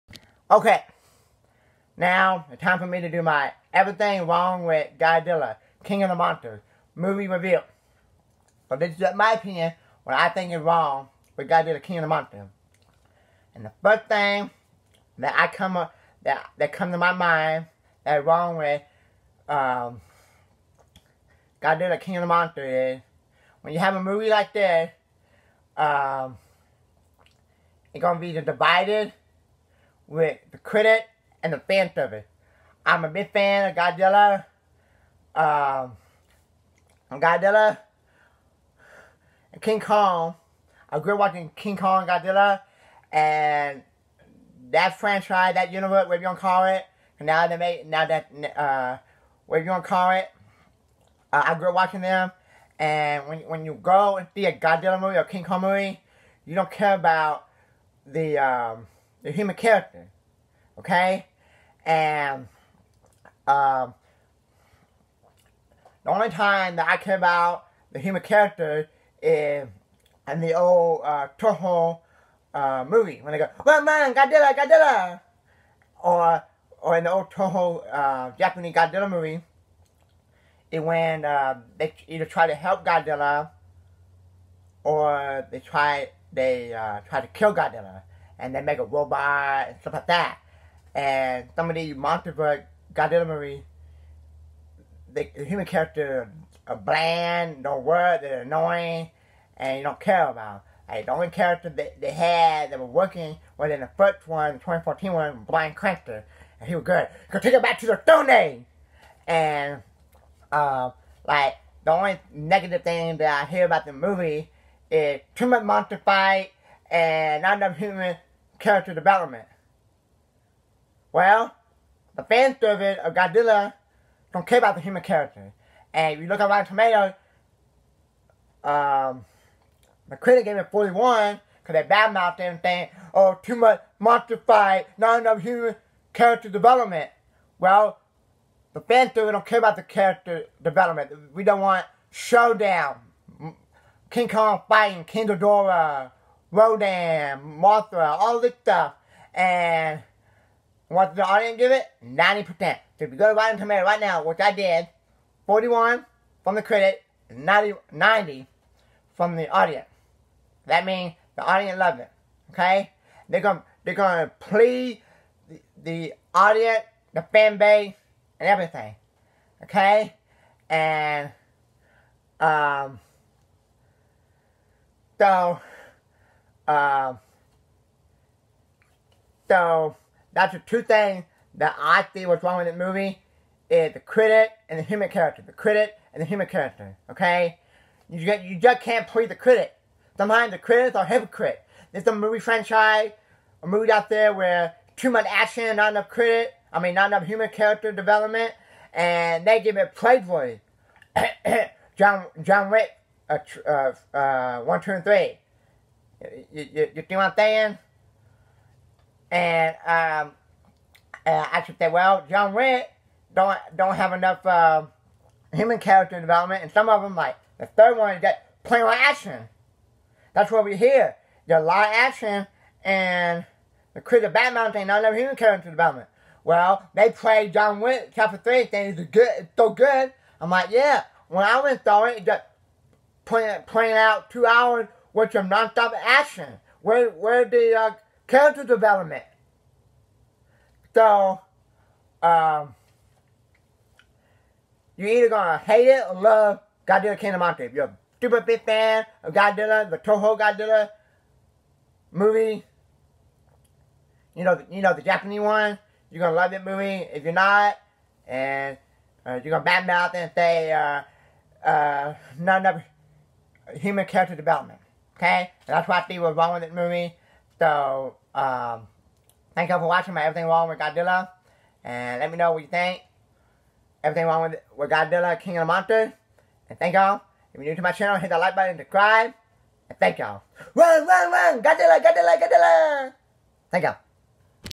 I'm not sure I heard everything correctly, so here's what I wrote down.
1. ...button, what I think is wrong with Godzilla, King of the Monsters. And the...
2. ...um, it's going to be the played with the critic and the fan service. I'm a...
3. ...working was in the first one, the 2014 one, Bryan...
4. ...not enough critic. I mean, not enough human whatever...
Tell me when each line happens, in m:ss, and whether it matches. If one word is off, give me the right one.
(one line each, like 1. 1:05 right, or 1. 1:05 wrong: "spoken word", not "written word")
1. 0:09 wrong: "opinion", not "button"
2. 0:25 wrong: "divided", not "played"
3. 1:42 right
4. 3:15 wrong: "character", not "whatever".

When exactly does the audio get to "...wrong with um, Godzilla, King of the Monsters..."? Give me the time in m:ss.
0:18.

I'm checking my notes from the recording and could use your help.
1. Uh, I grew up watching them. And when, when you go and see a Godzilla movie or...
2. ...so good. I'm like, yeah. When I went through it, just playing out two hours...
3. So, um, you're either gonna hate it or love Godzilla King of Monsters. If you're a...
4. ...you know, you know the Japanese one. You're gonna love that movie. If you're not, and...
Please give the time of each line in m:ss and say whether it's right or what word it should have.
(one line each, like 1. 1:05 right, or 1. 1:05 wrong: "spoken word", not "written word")
1. 0:51 right
2. 3:49 right
3. 4:00 right
4. 4:14 right.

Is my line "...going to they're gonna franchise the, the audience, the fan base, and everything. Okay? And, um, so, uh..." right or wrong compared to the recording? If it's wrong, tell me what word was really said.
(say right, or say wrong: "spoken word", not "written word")
wrong: "please", not "franchise".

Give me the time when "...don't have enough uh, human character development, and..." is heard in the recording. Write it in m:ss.
3:33.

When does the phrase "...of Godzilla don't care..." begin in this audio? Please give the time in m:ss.
2:03.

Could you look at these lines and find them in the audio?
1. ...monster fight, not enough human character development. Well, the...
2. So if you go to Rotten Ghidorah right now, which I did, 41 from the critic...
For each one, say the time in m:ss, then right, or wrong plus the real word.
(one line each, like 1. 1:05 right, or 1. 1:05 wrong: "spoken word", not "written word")
1. 2:13 right
2. 2:32 wrong: "Tomatoes", not "Ghidorah".